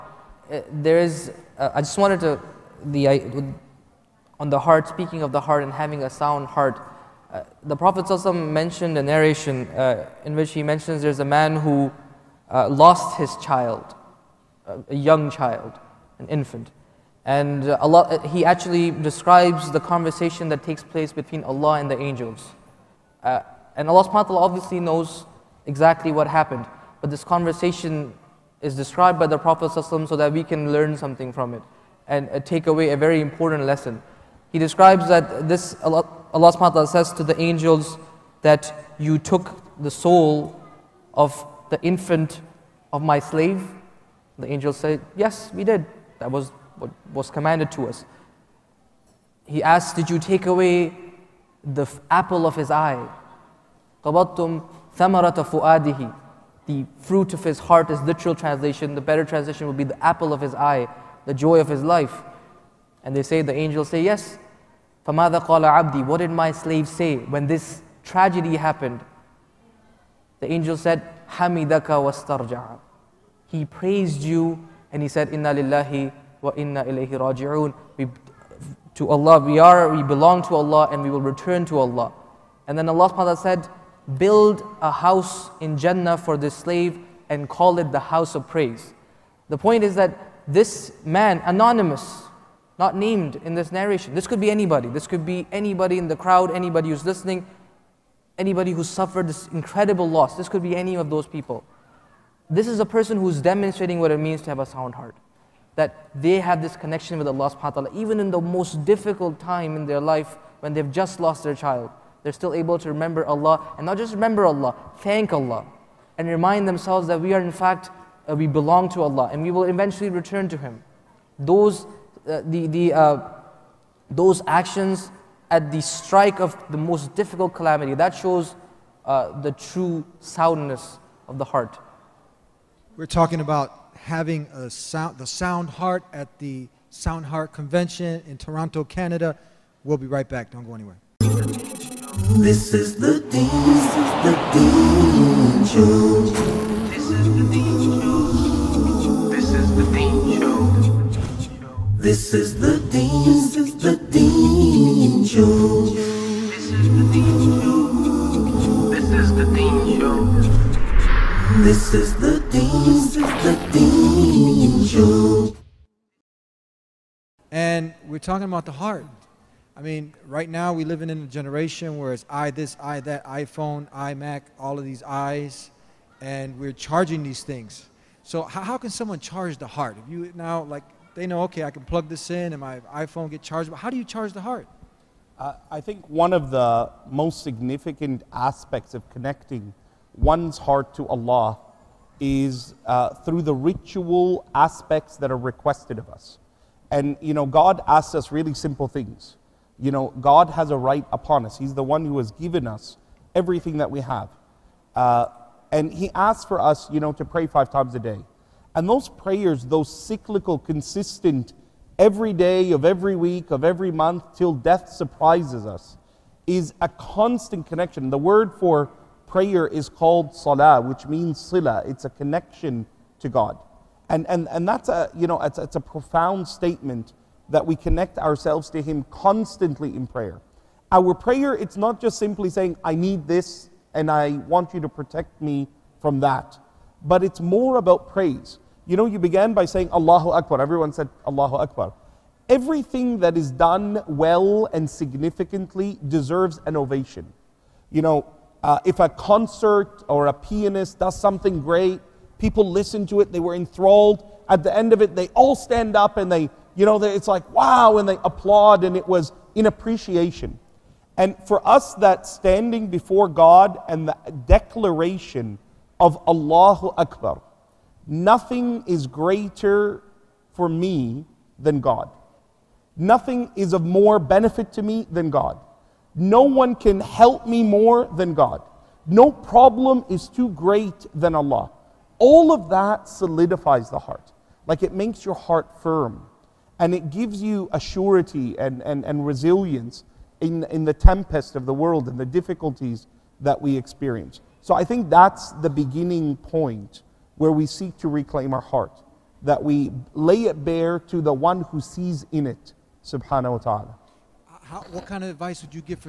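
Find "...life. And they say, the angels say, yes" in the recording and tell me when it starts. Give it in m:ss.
1:01.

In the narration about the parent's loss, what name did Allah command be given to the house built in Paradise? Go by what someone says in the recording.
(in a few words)
The house of praise.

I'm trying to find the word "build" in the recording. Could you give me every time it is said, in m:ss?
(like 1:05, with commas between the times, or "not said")
1:24.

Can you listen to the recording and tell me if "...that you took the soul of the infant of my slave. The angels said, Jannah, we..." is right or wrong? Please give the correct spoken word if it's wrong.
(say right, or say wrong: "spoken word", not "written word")
wrong: "Yes", not "Jannah".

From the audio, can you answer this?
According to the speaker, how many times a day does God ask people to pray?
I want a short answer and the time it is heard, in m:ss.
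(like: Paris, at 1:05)
5, at 3:27.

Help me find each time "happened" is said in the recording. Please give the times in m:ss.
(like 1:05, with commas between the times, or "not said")
0:26, 1:08.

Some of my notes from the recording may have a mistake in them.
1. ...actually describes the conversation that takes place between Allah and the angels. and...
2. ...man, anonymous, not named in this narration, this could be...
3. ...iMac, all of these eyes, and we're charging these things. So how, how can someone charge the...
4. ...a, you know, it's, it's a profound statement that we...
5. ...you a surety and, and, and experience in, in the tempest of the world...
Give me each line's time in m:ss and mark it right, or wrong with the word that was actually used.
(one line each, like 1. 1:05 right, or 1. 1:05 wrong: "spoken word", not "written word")
1. 0:18 right
2. 1:31 right
3. 2:53 right
4. 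3:44 right
5. 4:47 wrong: "resilience", not "experience".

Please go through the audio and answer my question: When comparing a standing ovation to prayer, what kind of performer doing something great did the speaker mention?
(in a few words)
A pianist.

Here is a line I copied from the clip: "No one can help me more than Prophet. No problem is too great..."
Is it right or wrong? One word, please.
wrong.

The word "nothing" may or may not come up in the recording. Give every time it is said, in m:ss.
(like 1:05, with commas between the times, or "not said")
4:28, 4:32.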